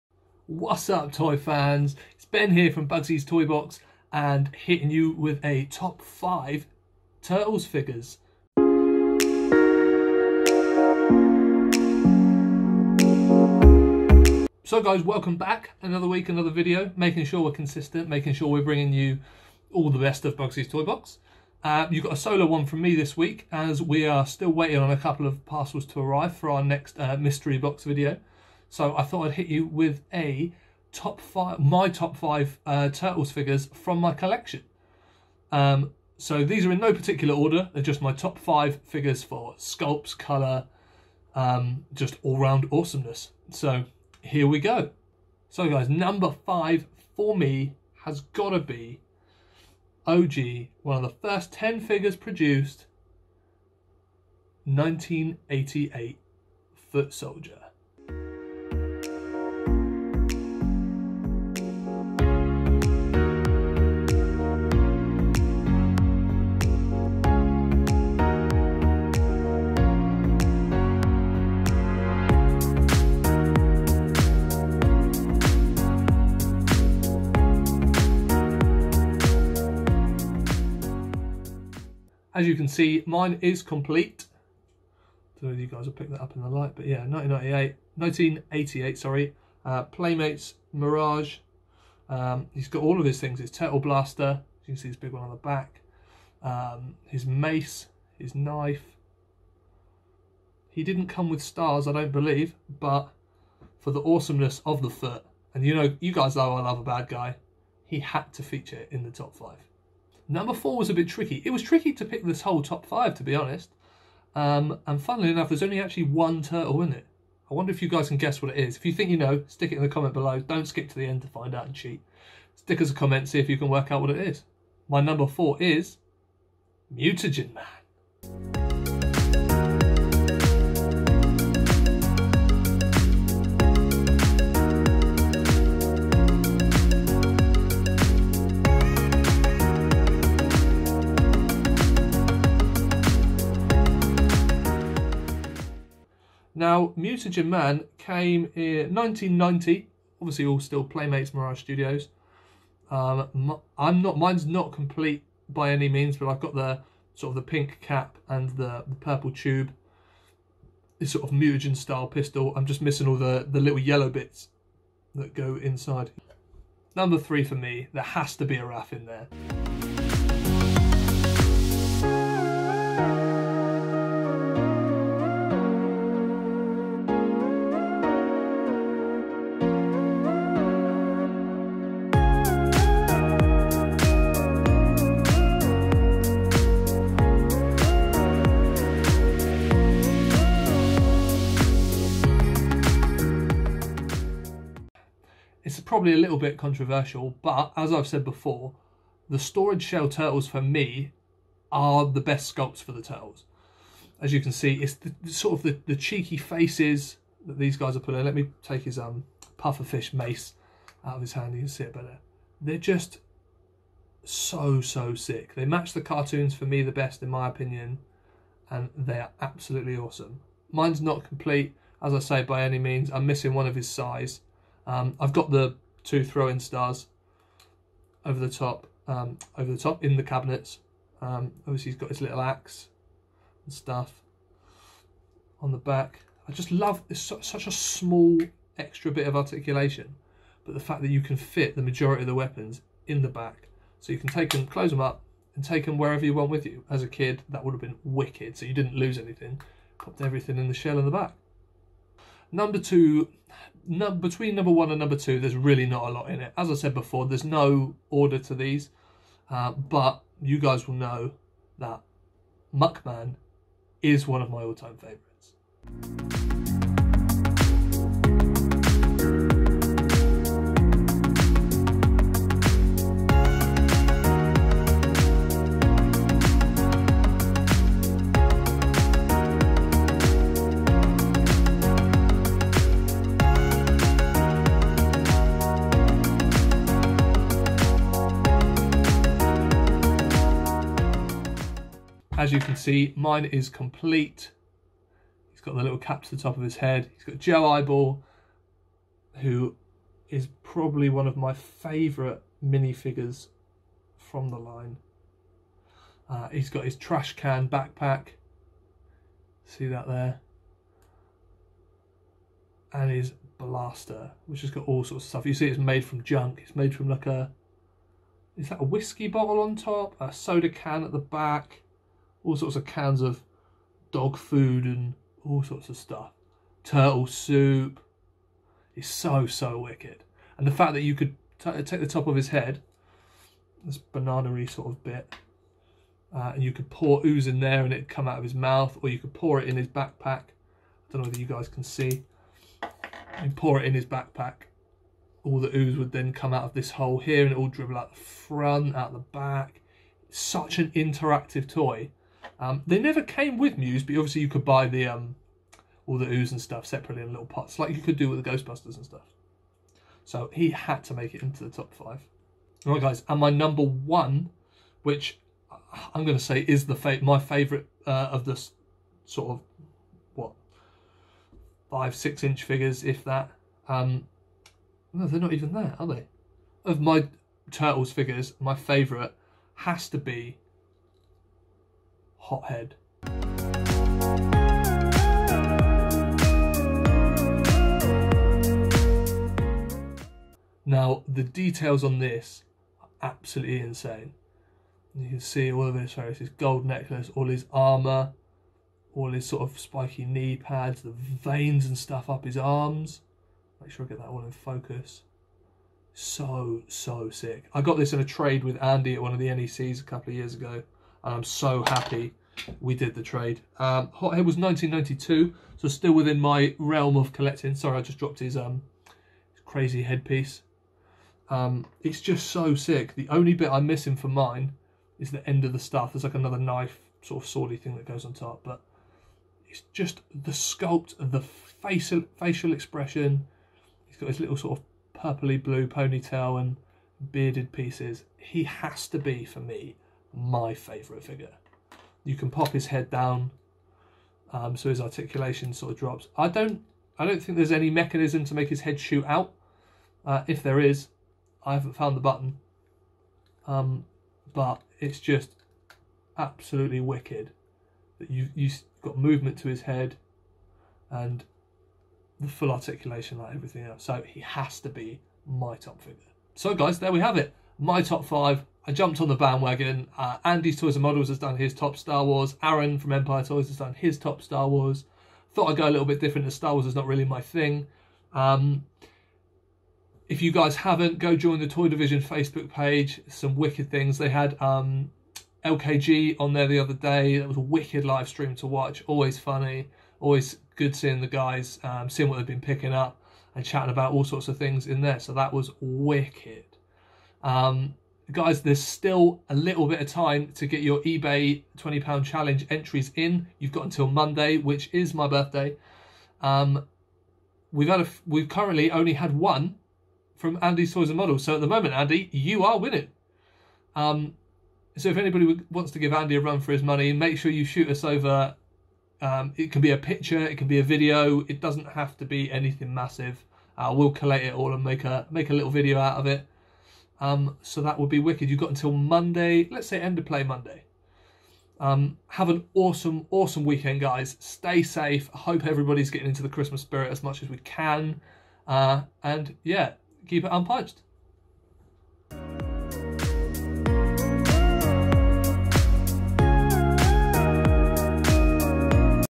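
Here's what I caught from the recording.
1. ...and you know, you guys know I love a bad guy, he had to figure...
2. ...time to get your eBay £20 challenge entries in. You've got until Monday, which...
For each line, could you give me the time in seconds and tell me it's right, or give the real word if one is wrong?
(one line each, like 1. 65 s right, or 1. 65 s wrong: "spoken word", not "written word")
1. 105 s wrong: "feature", not "figure"
2. 500 s right.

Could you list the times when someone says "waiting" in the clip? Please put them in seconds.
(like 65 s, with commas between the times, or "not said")
24 s.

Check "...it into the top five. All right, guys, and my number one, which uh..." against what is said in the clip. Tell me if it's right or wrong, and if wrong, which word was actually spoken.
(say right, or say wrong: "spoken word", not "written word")
right.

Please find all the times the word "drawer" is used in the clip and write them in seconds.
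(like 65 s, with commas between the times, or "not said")
not said.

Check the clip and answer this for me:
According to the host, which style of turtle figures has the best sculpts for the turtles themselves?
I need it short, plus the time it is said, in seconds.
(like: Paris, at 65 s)
storage shell turtles, at 199 s.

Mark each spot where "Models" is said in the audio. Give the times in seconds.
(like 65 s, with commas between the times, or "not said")
471 s, 511 s.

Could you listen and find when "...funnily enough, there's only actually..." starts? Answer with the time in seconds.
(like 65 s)
114 s.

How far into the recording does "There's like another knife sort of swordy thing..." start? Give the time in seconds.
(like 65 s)
426 s.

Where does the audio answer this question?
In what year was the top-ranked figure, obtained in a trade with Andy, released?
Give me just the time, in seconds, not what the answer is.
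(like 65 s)
414 s.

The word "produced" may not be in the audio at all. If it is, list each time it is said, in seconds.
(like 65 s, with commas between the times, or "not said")
52 s.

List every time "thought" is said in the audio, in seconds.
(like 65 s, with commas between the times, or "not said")
29 s, 475 s.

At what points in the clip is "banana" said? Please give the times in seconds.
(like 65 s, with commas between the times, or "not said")
333 s.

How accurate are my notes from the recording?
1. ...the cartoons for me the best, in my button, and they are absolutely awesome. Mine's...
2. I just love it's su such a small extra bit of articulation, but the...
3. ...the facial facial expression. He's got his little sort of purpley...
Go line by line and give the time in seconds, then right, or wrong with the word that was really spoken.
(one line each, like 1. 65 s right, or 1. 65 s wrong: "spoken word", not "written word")
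1. 215 s wrong: "opinion", not "button"
2. 236 s right
3. 431 s right.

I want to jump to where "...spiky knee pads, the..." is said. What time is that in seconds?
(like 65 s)
399 s.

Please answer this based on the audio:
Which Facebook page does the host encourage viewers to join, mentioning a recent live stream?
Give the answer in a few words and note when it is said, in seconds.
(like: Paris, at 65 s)
Toy Division, at 481 s.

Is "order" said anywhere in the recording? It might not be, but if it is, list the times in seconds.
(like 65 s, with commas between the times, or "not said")
37 s, 258 s.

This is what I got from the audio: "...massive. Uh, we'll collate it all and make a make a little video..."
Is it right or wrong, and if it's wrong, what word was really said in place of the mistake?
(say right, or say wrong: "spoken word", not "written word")
right.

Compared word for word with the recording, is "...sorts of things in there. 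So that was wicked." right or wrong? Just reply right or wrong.
right.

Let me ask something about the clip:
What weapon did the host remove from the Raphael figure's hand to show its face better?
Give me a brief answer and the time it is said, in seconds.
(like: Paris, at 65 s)
pufferfish mace, at 209 s.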